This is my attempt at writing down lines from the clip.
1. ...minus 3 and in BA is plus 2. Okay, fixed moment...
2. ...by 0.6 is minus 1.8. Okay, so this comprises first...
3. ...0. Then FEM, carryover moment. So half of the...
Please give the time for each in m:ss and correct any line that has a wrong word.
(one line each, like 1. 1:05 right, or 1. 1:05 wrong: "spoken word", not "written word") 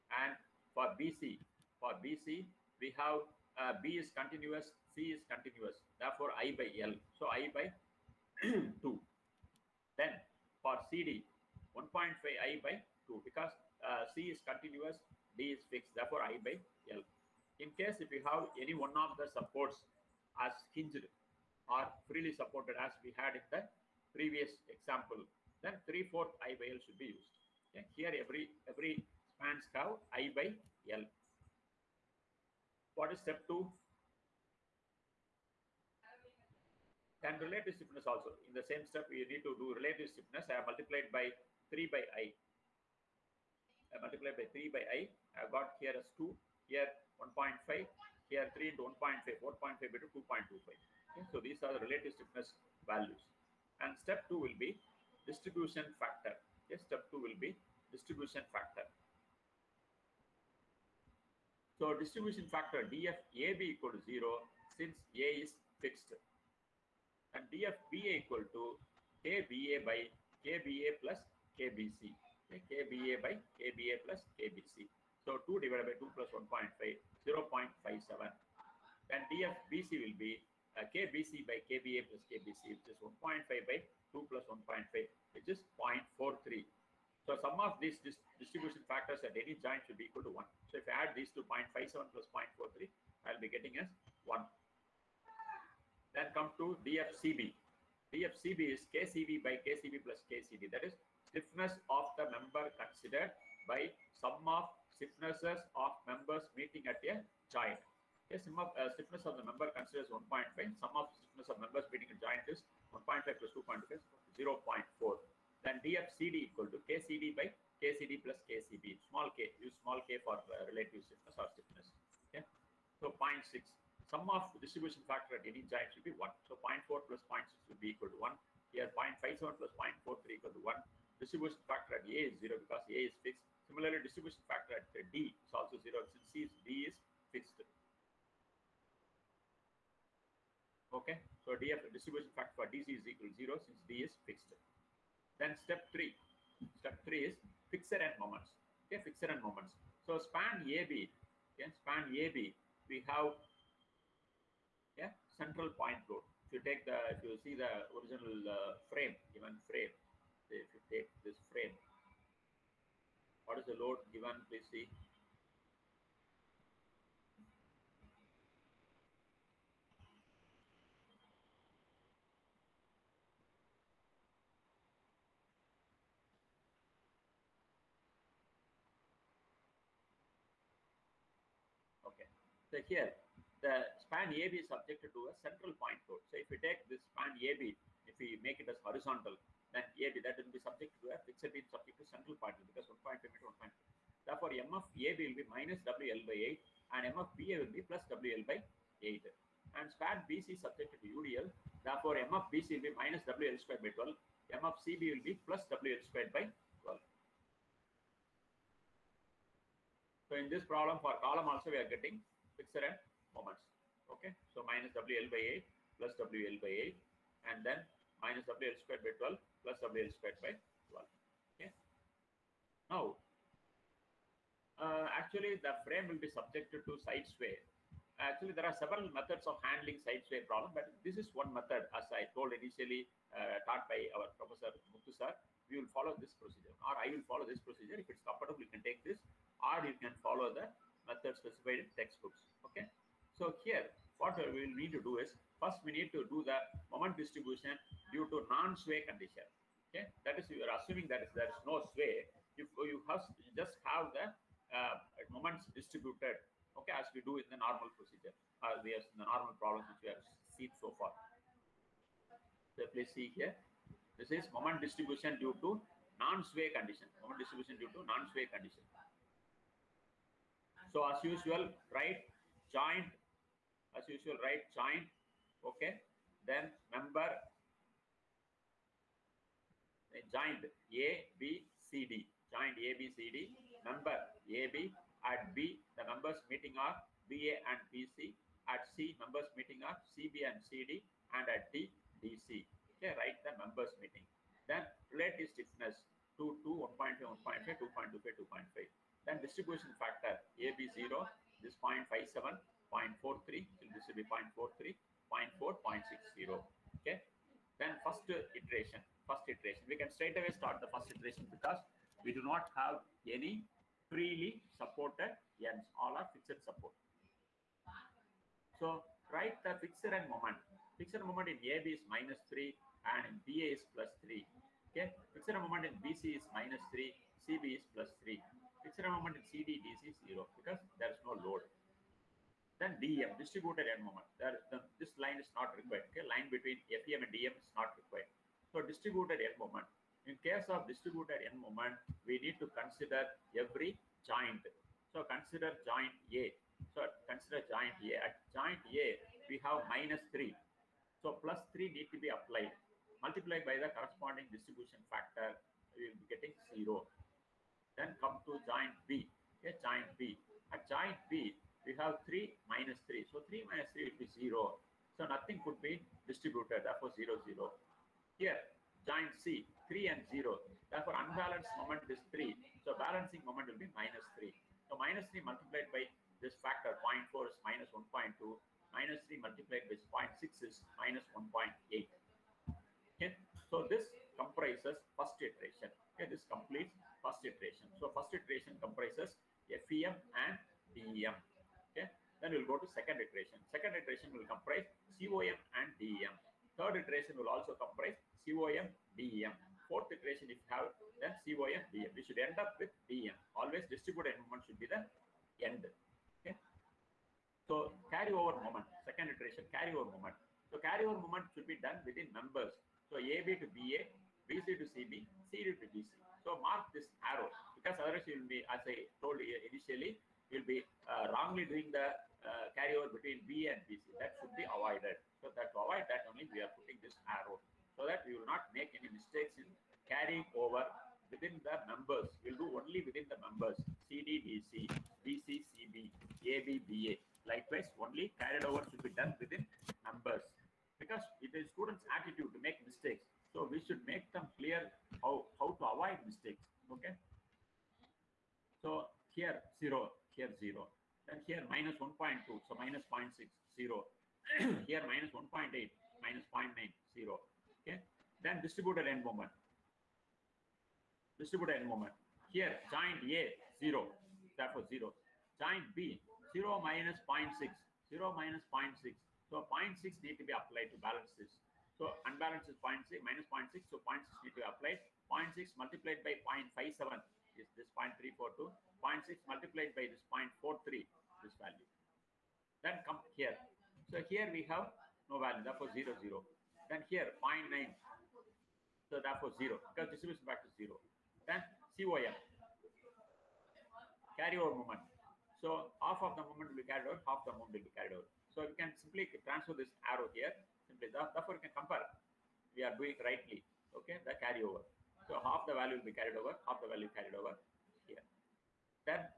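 1. 5:22 wrong: "3", not "2"
2. 6:19 right
3. 8:10 wrong: "COM", not "FEM".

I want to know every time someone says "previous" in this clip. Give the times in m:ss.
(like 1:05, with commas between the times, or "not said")
0:24.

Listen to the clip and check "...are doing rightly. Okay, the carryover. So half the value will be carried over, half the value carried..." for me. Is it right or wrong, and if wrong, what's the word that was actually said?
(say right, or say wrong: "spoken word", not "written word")
right.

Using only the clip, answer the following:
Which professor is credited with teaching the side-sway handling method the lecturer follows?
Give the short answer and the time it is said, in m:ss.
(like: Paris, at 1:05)
Muthu, at 3:54.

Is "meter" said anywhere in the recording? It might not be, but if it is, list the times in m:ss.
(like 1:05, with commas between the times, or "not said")
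3:13.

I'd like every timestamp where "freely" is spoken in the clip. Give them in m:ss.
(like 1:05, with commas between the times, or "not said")
0:22, 5:14.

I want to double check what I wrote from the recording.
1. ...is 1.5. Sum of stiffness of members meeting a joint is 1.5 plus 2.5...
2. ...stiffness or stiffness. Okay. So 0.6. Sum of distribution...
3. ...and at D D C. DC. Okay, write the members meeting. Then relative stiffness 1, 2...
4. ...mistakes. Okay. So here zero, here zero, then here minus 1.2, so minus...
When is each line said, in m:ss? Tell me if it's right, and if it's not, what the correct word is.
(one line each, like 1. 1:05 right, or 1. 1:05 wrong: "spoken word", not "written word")
1. 1:50 right
2. 2:01 right
3. 4:51 wrong: "2", not "1"
4. 7:26 right.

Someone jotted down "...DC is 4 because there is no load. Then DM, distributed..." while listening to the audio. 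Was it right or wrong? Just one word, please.
wrong.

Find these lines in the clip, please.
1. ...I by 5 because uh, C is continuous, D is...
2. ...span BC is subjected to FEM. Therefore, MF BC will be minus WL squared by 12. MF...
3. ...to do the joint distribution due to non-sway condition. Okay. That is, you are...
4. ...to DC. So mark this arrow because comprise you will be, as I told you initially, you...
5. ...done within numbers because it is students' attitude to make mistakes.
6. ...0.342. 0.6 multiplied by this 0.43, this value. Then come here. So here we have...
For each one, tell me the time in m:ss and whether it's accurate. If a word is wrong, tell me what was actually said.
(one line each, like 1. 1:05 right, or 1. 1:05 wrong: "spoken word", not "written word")
1. 0:12 wrong: "2", not "5"
2. 3:19 wrong: "UDL", not "FEM"
3. 4:06 wrong: "moment", not "joint"
4. 6:55 wrong: "otherwise", not "comprise"
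5. 7:19 right
6. 7:57 right.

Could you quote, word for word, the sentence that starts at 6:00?
At joint B, we have 3 minus 3.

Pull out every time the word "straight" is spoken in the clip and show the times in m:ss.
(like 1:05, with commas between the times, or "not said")
5:10.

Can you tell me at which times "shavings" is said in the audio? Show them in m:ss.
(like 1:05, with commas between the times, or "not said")
not said.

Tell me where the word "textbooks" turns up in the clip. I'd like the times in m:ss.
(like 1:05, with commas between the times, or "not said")
4:01.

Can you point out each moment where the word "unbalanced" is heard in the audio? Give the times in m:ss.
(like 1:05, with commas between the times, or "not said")
6:11, 7:52.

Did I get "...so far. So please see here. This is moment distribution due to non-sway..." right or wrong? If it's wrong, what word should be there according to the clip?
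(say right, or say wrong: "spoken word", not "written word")
right.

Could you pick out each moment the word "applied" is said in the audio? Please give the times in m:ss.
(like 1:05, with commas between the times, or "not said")
5:52, 7:50, 7:54.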